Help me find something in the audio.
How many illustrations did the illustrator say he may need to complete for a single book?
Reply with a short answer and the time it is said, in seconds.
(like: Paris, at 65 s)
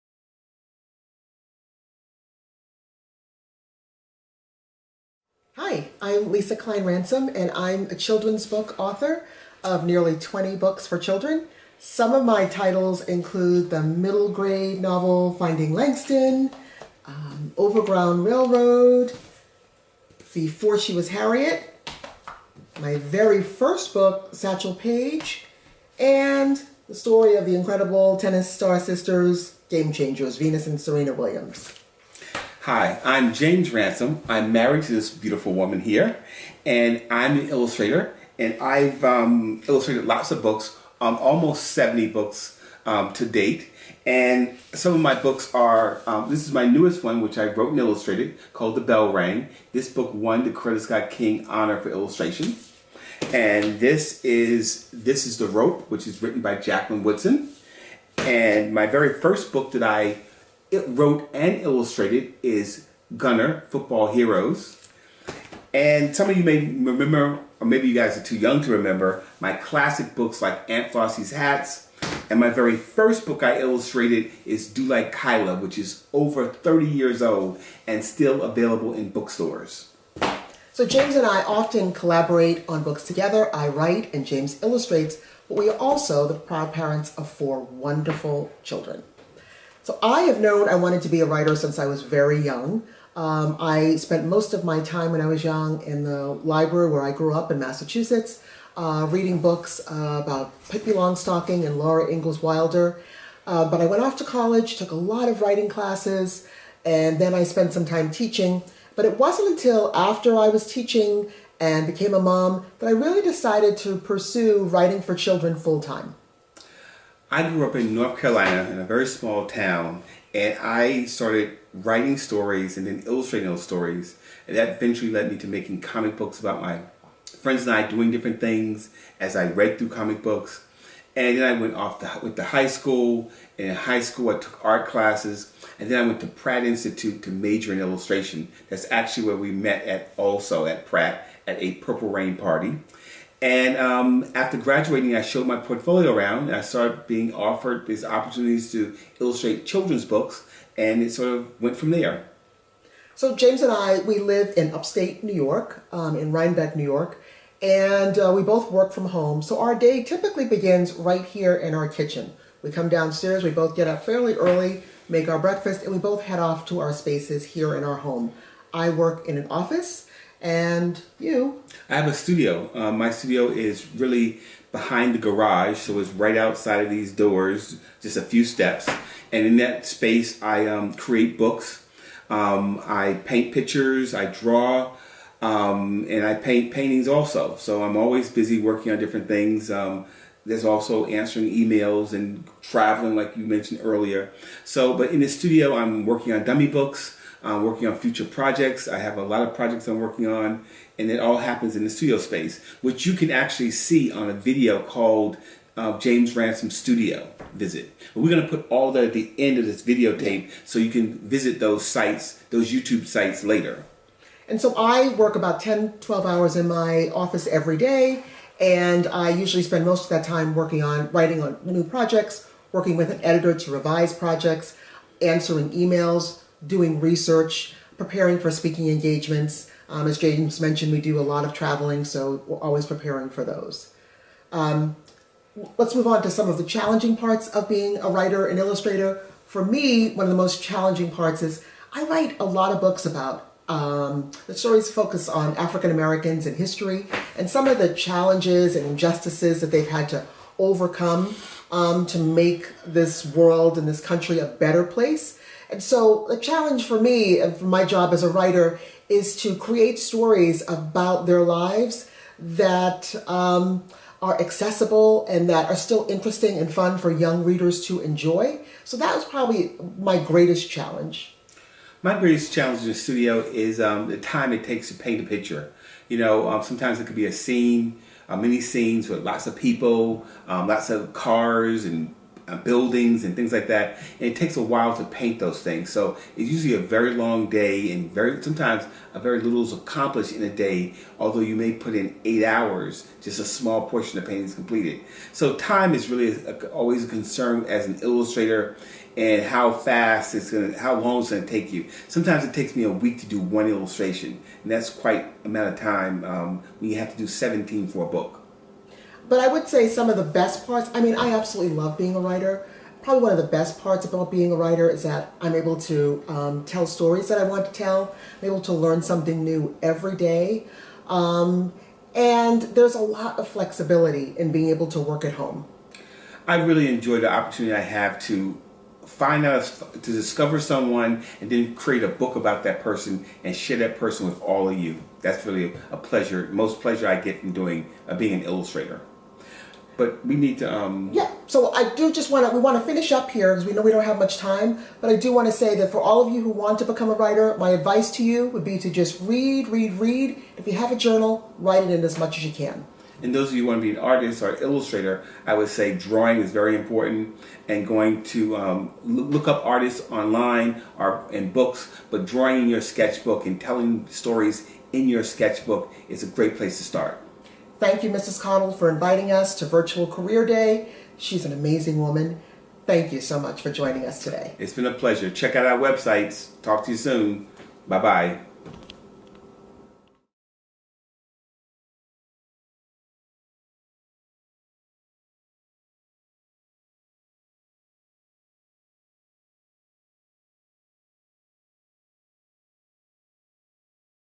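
17, at 307 s.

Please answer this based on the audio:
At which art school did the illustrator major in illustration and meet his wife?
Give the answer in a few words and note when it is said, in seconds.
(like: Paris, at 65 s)
Pratt Institute, at 136 s.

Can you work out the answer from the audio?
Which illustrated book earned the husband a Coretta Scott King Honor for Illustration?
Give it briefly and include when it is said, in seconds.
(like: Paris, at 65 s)
The Bell Rang, at 48 s.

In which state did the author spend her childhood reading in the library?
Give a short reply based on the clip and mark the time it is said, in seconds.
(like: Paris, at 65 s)
Massachusetts, at 97 s.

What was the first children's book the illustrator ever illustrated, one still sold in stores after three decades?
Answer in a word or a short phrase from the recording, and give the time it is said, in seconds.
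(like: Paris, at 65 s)
Do Like Kyla, at 74 s.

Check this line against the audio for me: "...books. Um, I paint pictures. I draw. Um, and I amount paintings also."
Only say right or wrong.
wrong.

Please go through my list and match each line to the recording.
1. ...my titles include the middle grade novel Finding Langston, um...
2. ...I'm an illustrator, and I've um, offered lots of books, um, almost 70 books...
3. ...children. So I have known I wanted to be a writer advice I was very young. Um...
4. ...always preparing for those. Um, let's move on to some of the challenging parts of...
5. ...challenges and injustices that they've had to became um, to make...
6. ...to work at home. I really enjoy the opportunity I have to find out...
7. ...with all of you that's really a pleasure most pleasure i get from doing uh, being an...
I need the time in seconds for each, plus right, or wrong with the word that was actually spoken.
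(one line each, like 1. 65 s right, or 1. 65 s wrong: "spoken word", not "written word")
1. 12 s right
2. 37 s wrong: "illustrated", not "offered"
3. 88 s wrong: "since", not "advice"
4. 232 s right
5. 247 s wrong: "overcome", not "became"
6. 324 s right
7. 334 s right.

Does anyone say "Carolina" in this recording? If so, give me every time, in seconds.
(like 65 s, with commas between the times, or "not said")
118 s.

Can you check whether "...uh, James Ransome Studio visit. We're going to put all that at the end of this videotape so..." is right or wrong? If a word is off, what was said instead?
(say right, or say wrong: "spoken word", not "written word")
right.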